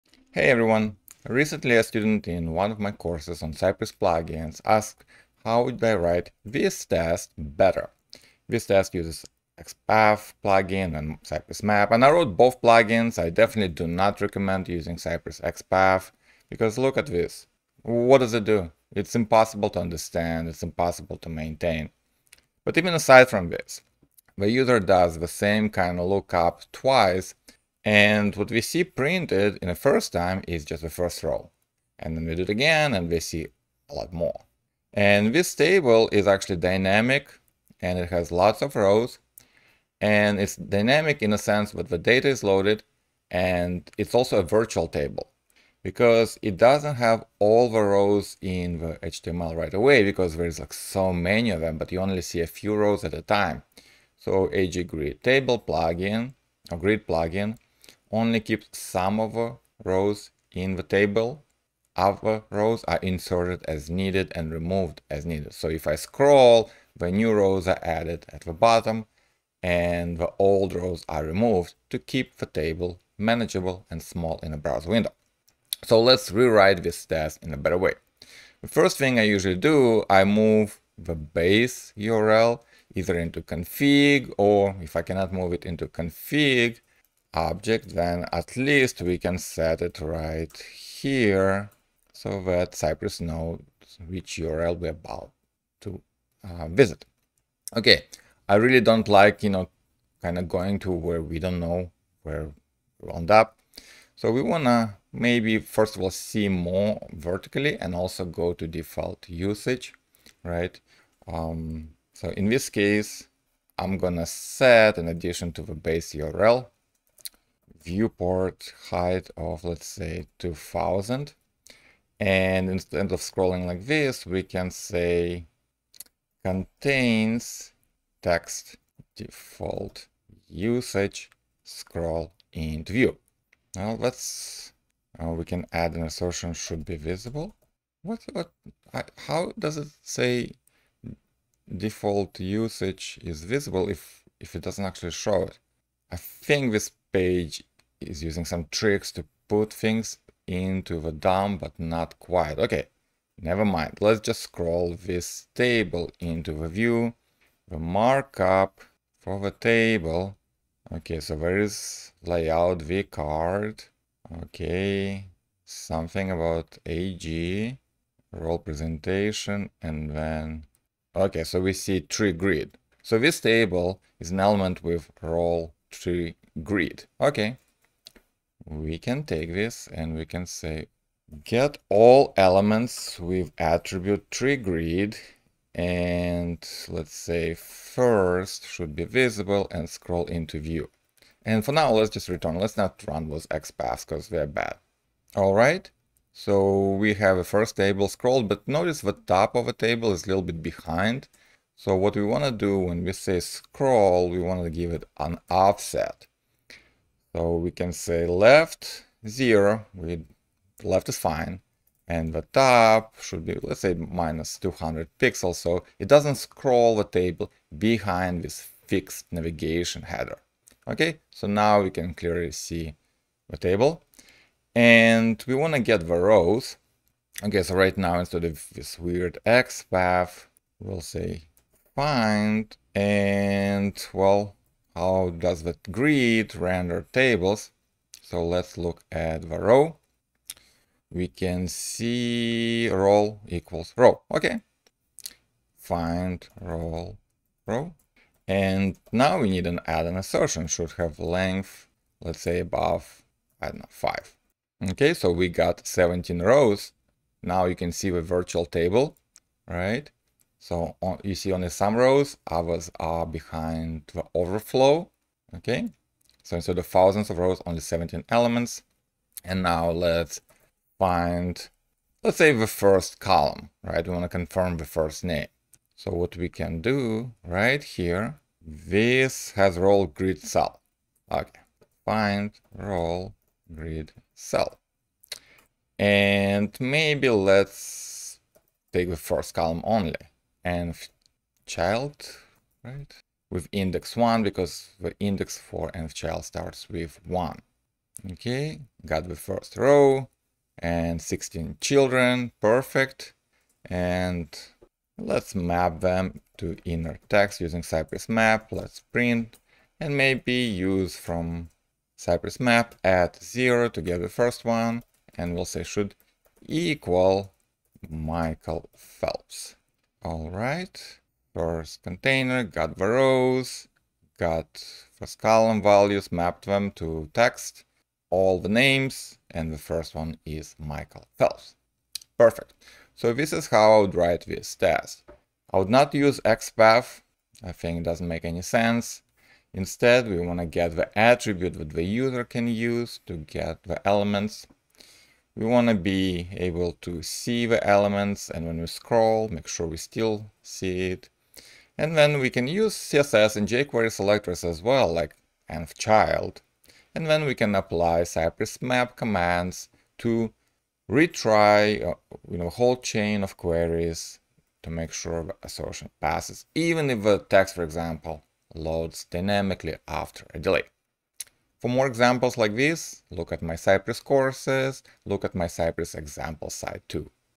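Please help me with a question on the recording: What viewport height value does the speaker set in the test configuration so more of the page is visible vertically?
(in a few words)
2000.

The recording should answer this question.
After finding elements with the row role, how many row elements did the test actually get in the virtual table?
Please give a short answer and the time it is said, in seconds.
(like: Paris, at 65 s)
17, at 255 s.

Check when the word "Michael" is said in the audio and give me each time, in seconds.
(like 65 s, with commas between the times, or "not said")
318 s, 330 s.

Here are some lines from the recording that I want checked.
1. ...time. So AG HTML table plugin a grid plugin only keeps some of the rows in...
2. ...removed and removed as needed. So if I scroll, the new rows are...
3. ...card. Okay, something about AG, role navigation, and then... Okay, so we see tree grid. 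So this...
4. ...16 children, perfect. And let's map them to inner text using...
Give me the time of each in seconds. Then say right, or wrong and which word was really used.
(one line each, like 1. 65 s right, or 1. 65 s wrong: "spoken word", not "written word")
1. 53 s wrong: "Grid", not "HTML"
2. 63 s wrong: "needed", not "removed"
3. 163 s wrong: "presentation", not "navigation"
4. 301 s right.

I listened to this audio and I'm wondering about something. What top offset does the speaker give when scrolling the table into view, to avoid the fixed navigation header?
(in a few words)
-200 pixels.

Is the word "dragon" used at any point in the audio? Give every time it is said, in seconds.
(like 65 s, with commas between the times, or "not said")
not said.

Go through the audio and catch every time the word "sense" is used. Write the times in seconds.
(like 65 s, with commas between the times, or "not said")
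41 s, 338 s.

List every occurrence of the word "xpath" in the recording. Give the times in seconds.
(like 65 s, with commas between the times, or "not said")
9 s, 15 s, 193 s, 336 s.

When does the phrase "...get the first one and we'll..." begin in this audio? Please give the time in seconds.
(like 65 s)
314 s.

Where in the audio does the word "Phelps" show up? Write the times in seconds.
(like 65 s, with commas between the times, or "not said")
318 s, 331 s.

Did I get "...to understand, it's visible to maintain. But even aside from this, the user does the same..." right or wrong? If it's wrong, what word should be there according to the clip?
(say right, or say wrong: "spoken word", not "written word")
wrong: "impossible", not "visible".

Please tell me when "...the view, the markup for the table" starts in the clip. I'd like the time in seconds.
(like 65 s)
156 s.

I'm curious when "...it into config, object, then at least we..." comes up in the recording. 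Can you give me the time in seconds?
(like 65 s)
85 s.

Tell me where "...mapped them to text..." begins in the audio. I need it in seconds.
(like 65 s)
326 s.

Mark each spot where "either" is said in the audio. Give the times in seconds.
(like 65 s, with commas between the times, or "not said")
82 s.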